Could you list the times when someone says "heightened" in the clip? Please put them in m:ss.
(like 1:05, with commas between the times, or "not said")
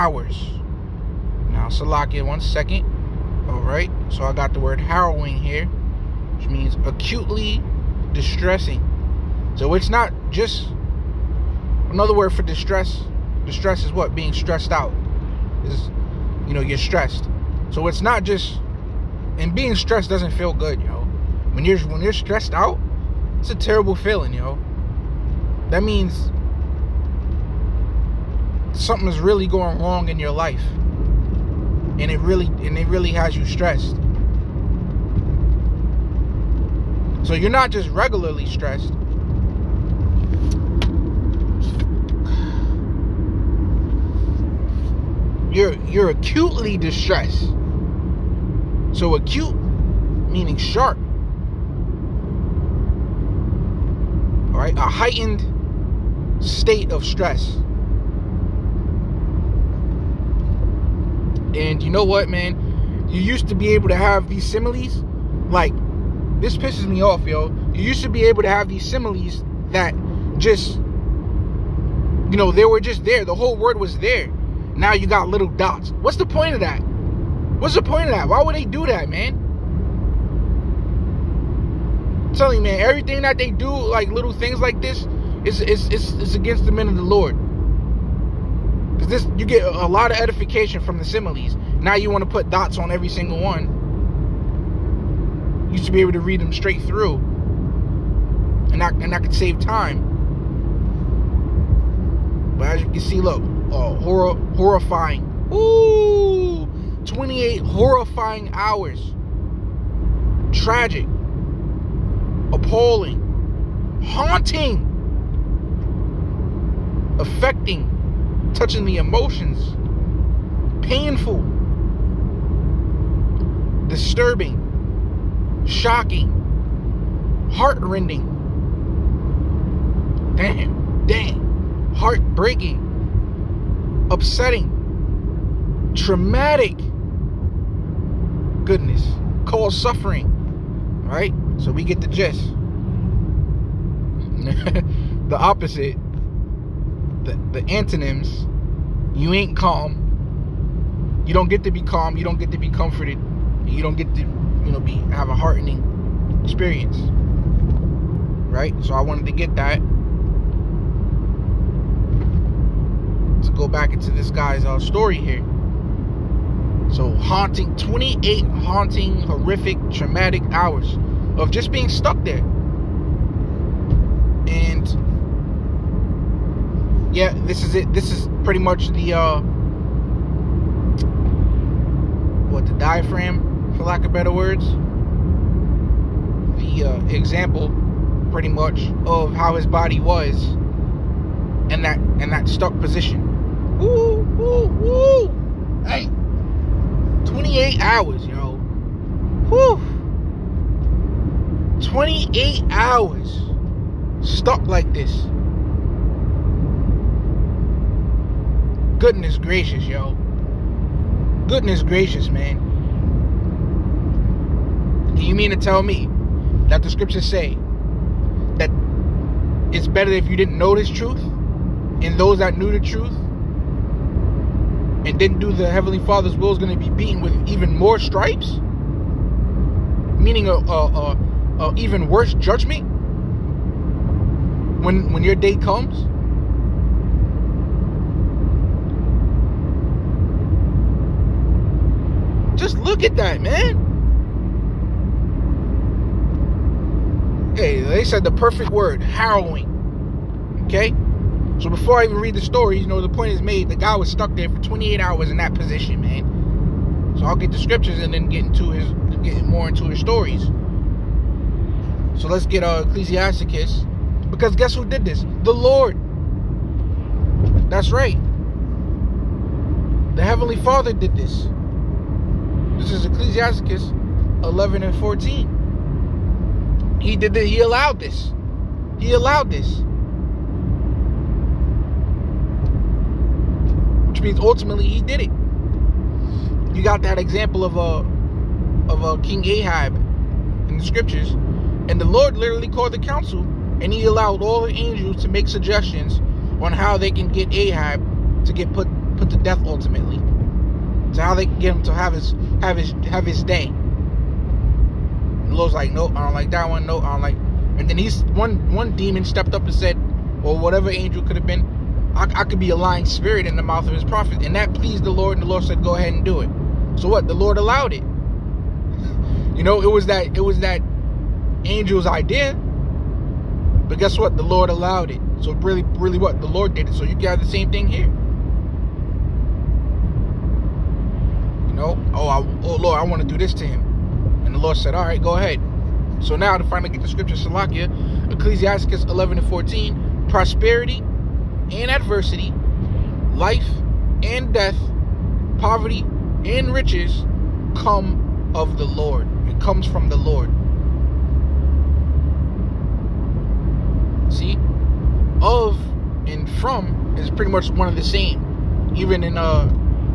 0:54.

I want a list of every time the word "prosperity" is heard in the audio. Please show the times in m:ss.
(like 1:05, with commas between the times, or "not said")
5:40.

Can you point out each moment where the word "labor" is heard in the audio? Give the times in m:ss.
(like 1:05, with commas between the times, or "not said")
not said.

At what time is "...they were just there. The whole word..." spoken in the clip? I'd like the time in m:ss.
1:12.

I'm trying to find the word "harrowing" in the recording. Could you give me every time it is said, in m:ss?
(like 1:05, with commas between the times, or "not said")
0:04, 4:09.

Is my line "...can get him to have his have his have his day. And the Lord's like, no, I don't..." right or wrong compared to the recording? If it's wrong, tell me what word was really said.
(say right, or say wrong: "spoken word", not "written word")
right.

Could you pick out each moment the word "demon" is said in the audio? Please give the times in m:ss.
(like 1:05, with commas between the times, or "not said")
5:08.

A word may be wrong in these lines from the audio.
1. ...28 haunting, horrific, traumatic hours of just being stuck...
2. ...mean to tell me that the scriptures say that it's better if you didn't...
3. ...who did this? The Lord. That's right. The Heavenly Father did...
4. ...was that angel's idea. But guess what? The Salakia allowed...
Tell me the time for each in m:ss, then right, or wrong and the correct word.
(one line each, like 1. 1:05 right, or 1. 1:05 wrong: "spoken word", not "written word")
1. 2:47 right
2. 3:35 right
3. 4:24 right
4. 5:20 wrong: "Lord", not "Salakia".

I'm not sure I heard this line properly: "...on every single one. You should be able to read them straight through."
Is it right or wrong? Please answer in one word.
right.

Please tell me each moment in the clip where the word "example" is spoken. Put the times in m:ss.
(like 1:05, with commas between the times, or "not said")
3:07, 4:47.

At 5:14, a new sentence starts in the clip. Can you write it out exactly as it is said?
And that pleased the Lord, and the Lord said, Go ahead and do it.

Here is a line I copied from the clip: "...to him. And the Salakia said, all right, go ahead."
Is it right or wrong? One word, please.
wrong.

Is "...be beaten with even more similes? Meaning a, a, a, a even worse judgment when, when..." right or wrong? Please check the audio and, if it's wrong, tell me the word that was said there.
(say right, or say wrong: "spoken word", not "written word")
wrong: "stripes", not "similes".